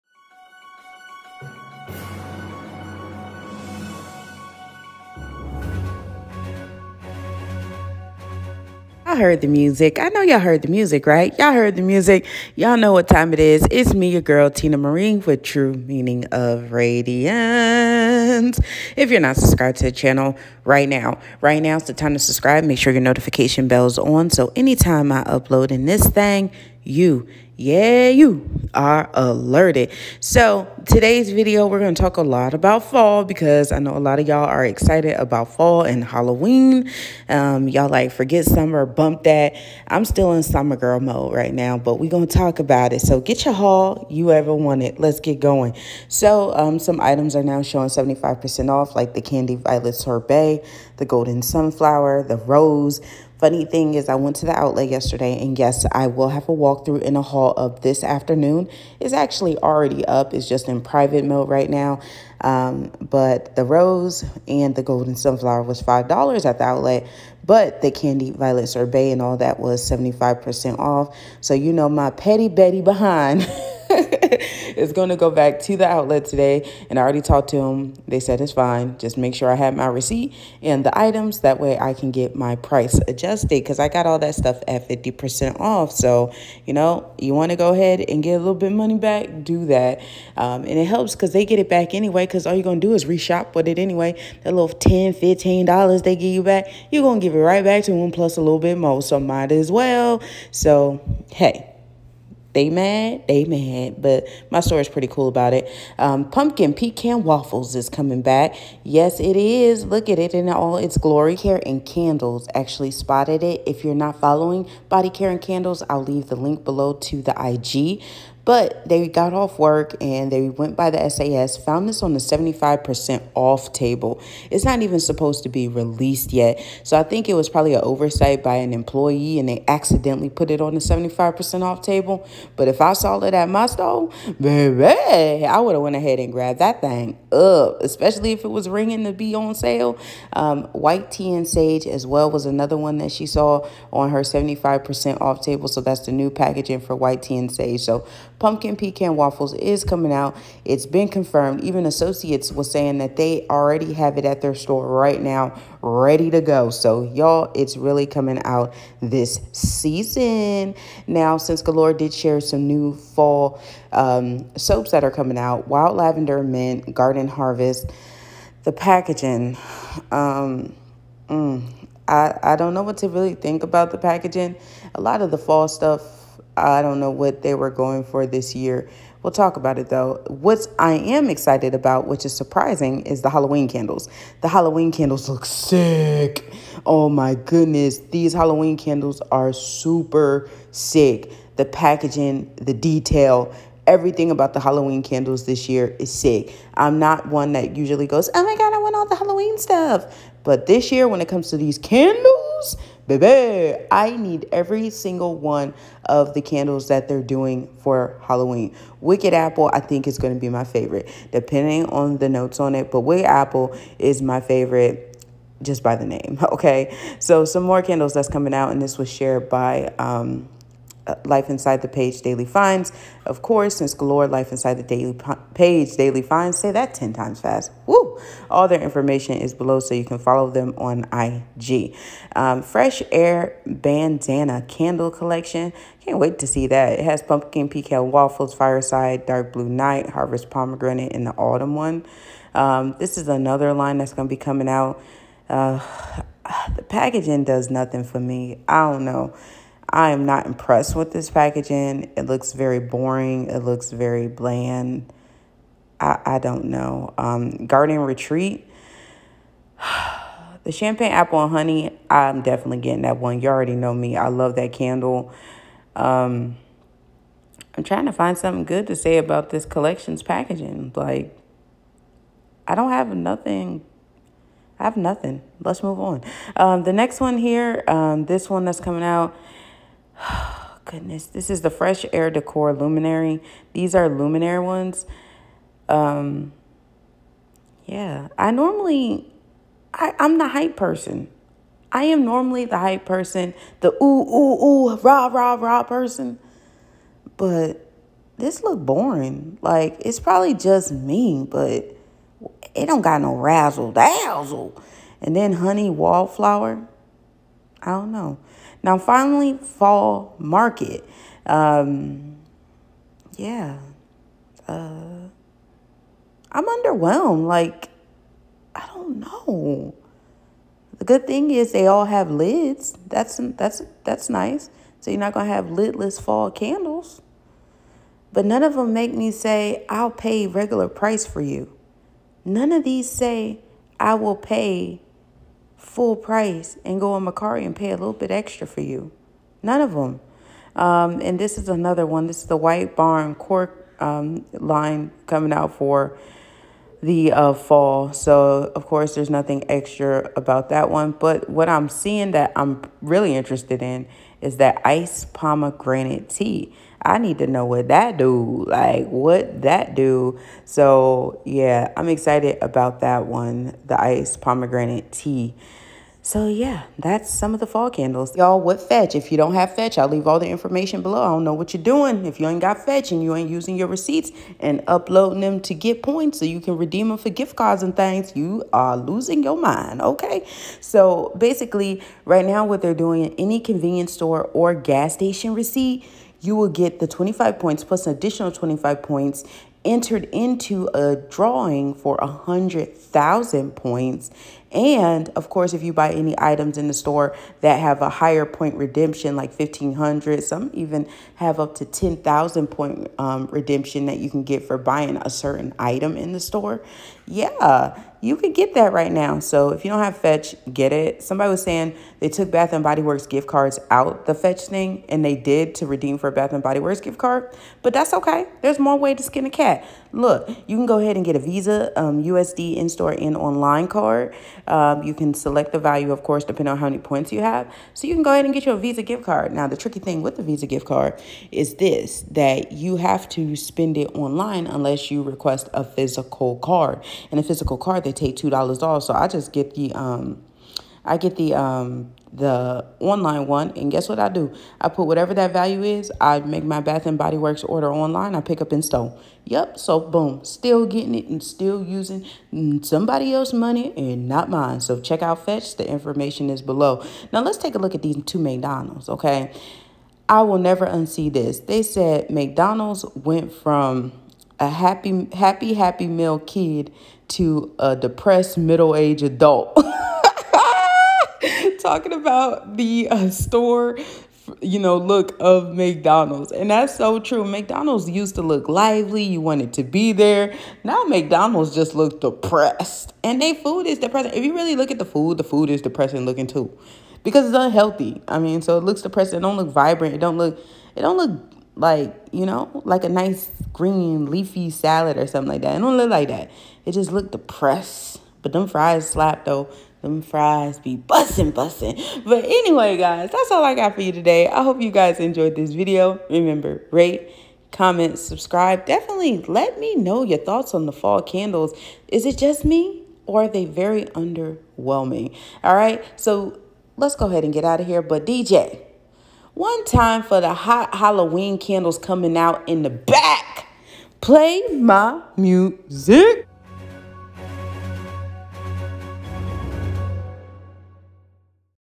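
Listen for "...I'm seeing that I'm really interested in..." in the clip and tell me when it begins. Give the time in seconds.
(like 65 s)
351 s.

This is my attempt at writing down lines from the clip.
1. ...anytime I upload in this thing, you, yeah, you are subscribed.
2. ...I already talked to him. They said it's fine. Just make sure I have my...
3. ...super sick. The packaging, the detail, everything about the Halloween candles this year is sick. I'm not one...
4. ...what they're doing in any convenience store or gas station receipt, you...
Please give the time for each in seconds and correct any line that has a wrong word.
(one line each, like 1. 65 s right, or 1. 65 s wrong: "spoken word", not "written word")
1. 24 s wrong: "alerted", not "subscribed"
2. 76 s right
3. 189 s right
4. 382 s right.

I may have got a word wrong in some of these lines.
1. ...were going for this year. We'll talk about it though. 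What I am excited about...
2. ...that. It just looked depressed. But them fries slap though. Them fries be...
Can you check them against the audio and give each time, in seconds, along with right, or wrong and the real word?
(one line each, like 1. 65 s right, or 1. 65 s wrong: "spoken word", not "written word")
1. 177 s right
2. 496 s right.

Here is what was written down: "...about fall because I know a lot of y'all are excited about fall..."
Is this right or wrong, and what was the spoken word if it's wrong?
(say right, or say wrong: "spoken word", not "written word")
right.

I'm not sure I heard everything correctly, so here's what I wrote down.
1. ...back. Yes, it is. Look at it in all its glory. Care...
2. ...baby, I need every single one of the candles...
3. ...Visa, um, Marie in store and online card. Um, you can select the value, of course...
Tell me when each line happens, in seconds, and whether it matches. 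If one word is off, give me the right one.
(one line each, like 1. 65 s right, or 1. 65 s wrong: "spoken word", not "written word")
1. 108 s right
2. 203 s right
3. 421 s wrong: "USD", not "Marie".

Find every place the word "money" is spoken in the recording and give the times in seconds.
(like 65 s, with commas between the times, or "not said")
88 s, 453 s.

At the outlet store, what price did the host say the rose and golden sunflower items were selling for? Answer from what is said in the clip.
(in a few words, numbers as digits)
$5.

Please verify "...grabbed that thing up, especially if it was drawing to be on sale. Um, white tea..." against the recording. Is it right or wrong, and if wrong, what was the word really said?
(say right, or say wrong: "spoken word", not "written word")
wrong: "ringing", not "drawing".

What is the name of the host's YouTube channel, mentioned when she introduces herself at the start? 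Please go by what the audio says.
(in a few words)
True Meaning of Radiance.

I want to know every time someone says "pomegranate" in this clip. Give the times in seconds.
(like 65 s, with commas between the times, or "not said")
240 s, 355 s, 364 s.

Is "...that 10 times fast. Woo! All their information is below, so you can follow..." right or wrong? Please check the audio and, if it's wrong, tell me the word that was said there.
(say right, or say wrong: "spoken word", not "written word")
right.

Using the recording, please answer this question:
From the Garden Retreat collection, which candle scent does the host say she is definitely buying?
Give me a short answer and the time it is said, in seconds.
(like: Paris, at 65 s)
Champagne Apple and Honey, at 260 s.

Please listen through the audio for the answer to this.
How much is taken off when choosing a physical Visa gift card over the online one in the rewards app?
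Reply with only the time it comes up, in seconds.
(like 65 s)
438 s.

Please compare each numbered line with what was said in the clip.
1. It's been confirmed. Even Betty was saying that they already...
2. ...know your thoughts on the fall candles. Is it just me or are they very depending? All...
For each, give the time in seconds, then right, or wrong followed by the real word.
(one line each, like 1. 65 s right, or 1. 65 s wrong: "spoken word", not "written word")
1. 150 s wrong: "Associates", not "Betty"
2. 509 s wrong: "underwhelming", not "depending".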